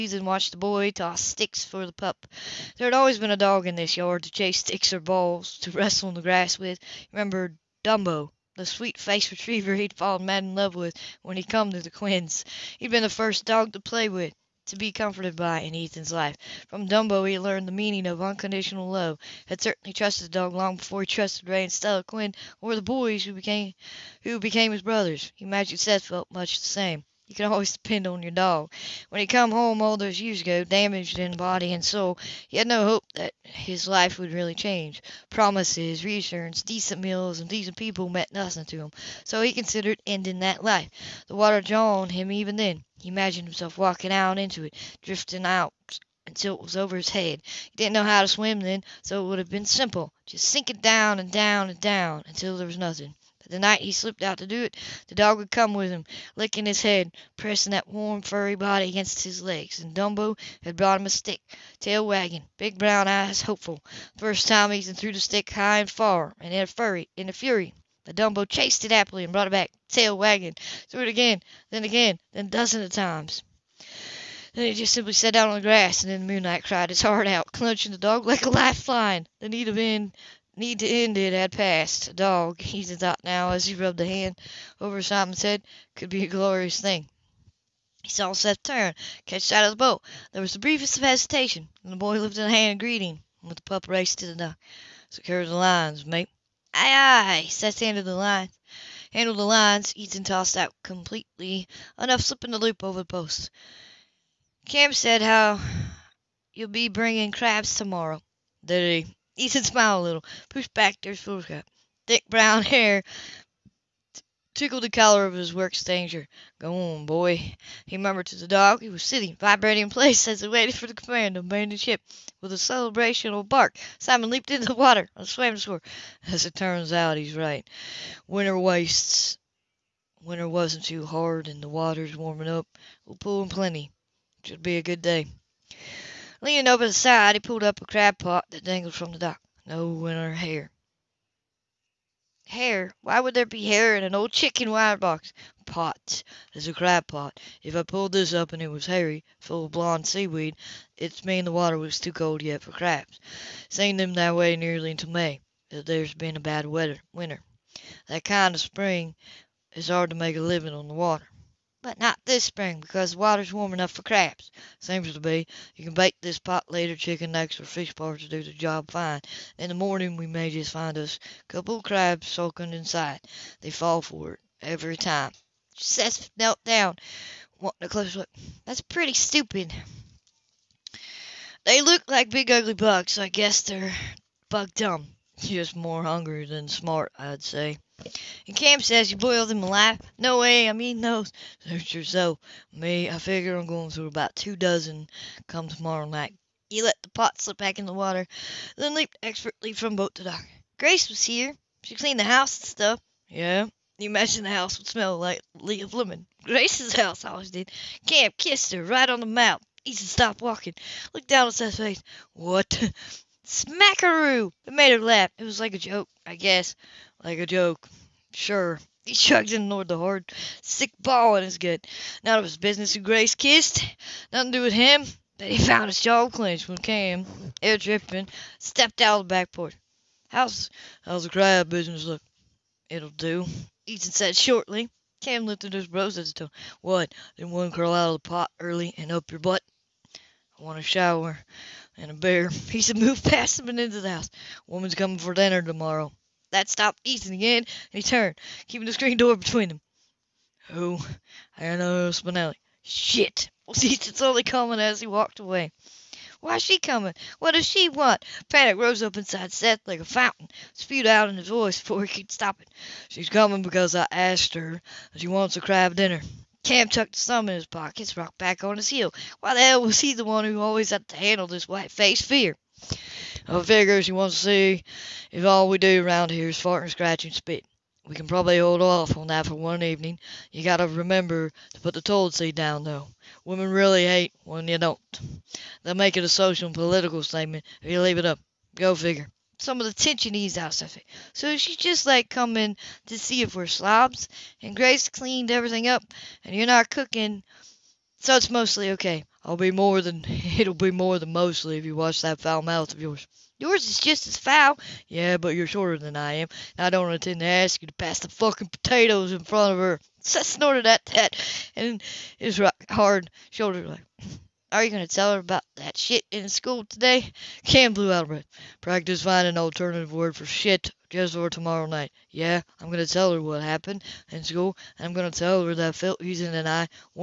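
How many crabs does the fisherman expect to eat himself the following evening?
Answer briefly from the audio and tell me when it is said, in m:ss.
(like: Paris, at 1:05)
2 dozen, at 3:14.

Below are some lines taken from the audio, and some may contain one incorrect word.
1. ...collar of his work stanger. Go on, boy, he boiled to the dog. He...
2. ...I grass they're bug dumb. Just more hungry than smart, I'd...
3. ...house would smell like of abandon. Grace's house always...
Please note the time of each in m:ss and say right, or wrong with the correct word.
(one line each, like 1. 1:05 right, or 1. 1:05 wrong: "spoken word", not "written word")
1. 1:54 wrong: "murmured", not "boiled"
2. 3:03 wrong: "guess", not "grass"
3. 3:24 wrong: "lemon", not "abandon".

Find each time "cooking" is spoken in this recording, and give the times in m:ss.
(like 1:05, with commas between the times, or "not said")
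4:56.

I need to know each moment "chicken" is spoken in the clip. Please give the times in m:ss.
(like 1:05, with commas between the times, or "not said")
2:24, 2:46.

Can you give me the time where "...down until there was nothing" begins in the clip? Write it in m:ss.
0:51.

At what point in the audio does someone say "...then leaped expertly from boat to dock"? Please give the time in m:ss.
3:18.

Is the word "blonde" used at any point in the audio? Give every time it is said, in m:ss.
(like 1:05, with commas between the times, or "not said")
2:29.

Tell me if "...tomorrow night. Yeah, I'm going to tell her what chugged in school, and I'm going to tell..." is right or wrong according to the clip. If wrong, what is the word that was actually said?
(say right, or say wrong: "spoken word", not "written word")
wrong: "happened", not "chugged".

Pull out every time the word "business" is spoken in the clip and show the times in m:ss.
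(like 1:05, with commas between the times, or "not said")
3:42, 3:51.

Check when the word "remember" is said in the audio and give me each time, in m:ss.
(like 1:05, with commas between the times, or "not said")
0:07, 4:40.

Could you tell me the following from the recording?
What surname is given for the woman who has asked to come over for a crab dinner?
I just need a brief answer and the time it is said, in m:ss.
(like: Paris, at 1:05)
Spinelli, at 4:12.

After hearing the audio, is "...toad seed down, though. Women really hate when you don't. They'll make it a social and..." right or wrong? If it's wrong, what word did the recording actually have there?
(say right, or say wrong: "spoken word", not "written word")
right.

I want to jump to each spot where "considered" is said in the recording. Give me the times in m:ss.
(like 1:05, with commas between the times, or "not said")
0:39.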